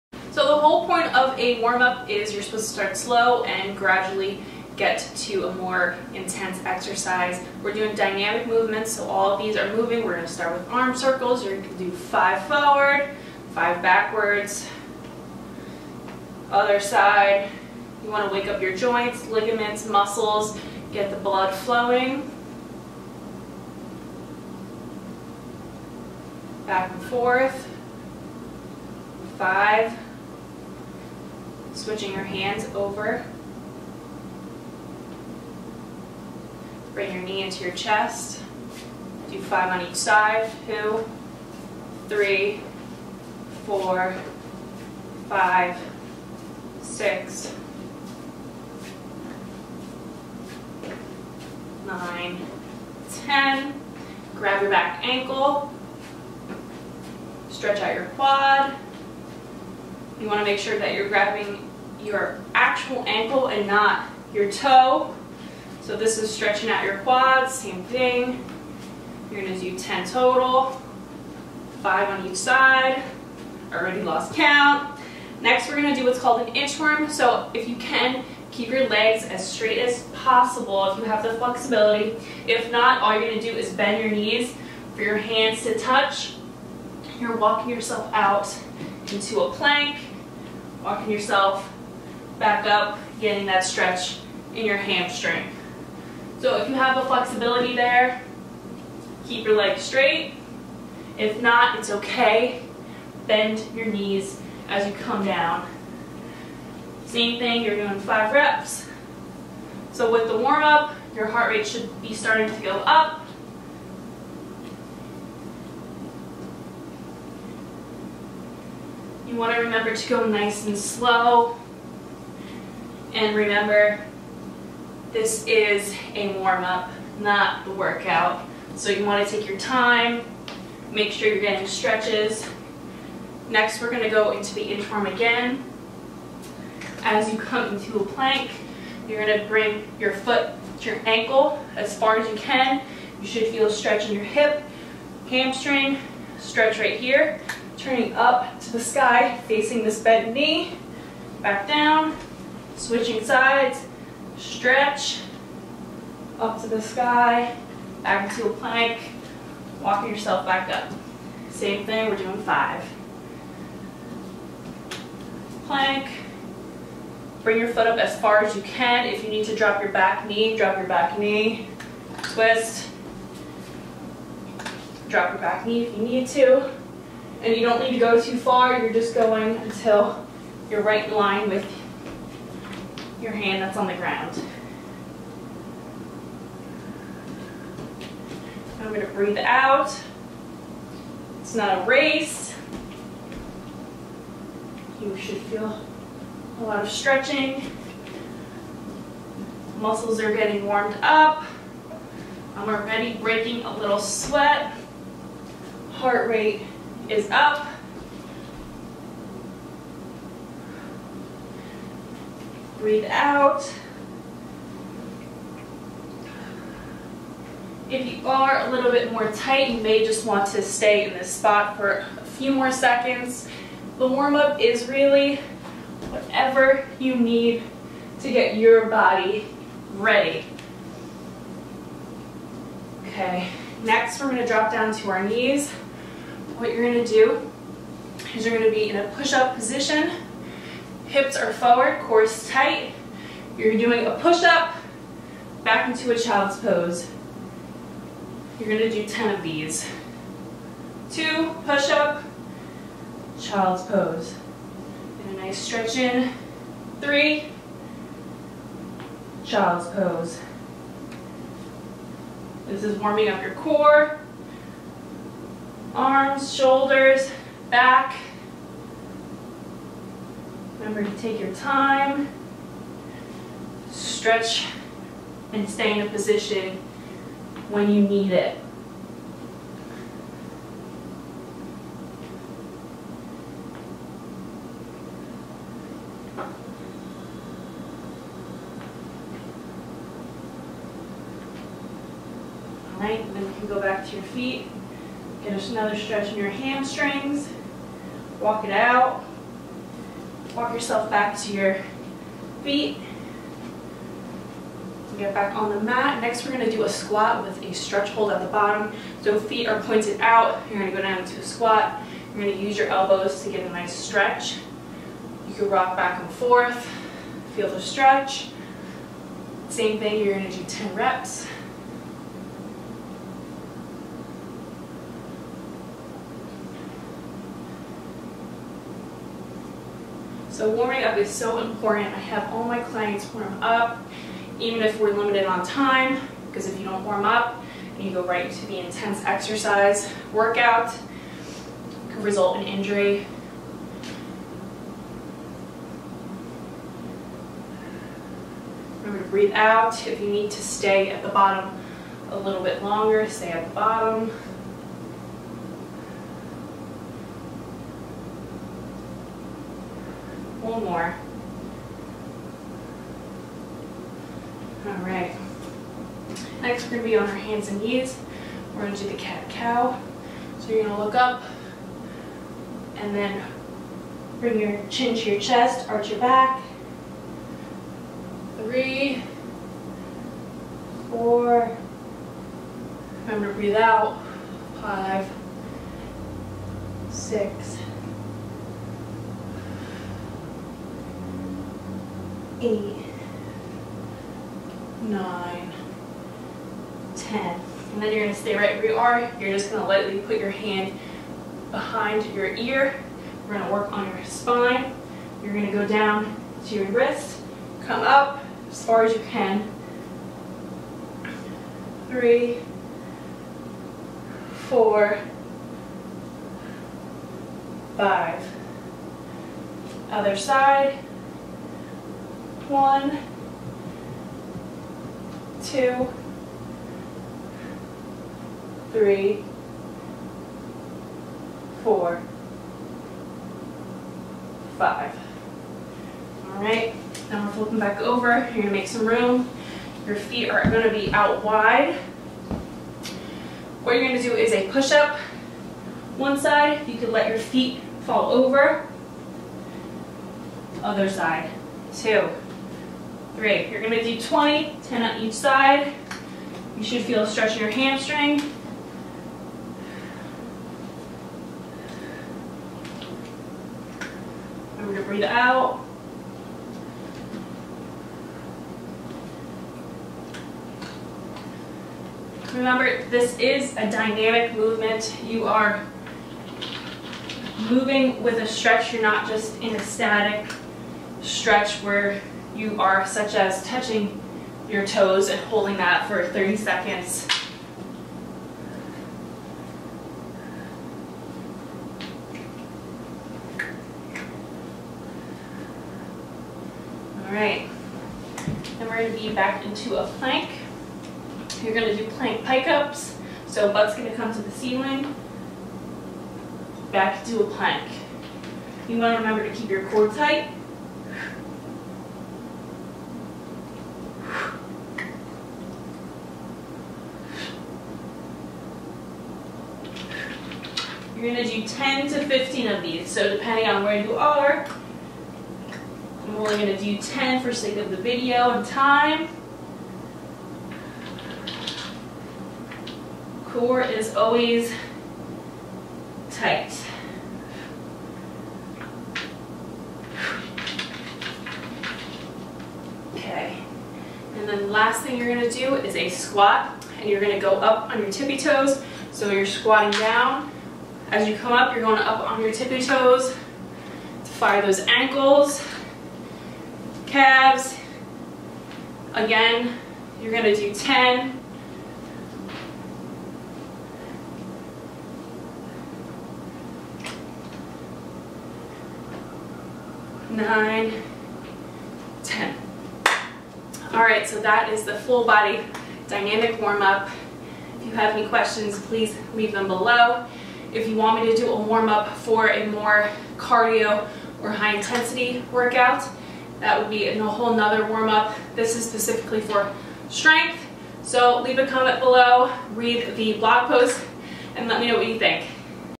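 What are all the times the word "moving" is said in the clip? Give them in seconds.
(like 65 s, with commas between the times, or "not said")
9 s, 477 s.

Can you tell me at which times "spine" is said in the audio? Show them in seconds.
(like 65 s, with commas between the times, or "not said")
404 s.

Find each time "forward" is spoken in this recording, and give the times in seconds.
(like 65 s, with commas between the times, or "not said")
12 s, 241 s.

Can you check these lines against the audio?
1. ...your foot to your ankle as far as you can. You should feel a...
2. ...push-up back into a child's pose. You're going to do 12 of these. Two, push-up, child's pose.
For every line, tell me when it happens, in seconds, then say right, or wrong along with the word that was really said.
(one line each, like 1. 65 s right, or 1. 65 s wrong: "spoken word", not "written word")
1. 139 s right
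2. 244 s wrong: "10", not "12".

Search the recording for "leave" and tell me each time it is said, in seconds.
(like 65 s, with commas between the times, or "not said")
579 s, 591 s.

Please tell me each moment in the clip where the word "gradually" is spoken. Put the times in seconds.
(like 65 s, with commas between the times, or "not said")
3 s.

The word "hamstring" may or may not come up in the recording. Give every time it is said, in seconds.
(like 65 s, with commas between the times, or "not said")
94 s, 145 s, 296 s, 457 s.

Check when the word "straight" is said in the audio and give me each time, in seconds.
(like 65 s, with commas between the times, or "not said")
79 s, 99 s.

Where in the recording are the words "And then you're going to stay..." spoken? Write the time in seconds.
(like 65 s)
397 s.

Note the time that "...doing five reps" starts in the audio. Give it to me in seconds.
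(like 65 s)
107 s.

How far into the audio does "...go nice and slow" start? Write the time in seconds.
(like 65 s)
120 s.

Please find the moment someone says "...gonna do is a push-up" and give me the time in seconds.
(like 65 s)
444 s.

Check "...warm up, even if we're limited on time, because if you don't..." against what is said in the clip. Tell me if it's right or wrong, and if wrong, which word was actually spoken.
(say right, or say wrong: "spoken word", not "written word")
right.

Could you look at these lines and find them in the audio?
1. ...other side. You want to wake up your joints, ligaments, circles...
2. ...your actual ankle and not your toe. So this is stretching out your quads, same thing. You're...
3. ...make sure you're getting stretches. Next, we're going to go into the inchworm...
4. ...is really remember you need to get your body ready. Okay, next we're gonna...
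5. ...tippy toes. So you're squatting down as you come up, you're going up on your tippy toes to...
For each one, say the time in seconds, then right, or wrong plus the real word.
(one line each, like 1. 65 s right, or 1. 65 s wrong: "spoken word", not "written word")
1. 16 s wrong: "muscles", not "circles"
2. 61 s right
3. 130 s right
4. 224 s wrong: "whatever", not "remember"
5. 548 s right.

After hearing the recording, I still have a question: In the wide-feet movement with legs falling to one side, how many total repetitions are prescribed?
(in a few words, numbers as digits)
20.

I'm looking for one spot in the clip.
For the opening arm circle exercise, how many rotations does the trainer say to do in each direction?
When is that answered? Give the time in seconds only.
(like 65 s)
11 s.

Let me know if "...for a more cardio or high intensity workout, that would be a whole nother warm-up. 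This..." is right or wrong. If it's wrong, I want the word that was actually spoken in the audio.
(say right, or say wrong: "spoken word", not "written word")
right.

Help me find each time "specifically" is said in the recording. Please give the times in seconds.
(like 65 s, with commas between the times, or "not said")
588 s.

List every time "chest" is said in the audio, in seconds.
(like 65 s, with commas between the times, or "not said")
37 s, 375 s.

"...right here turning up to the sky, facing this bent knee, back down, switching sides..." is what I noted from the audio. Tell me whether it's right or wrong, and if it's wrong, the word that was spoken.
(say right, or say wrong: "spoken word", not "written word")
right.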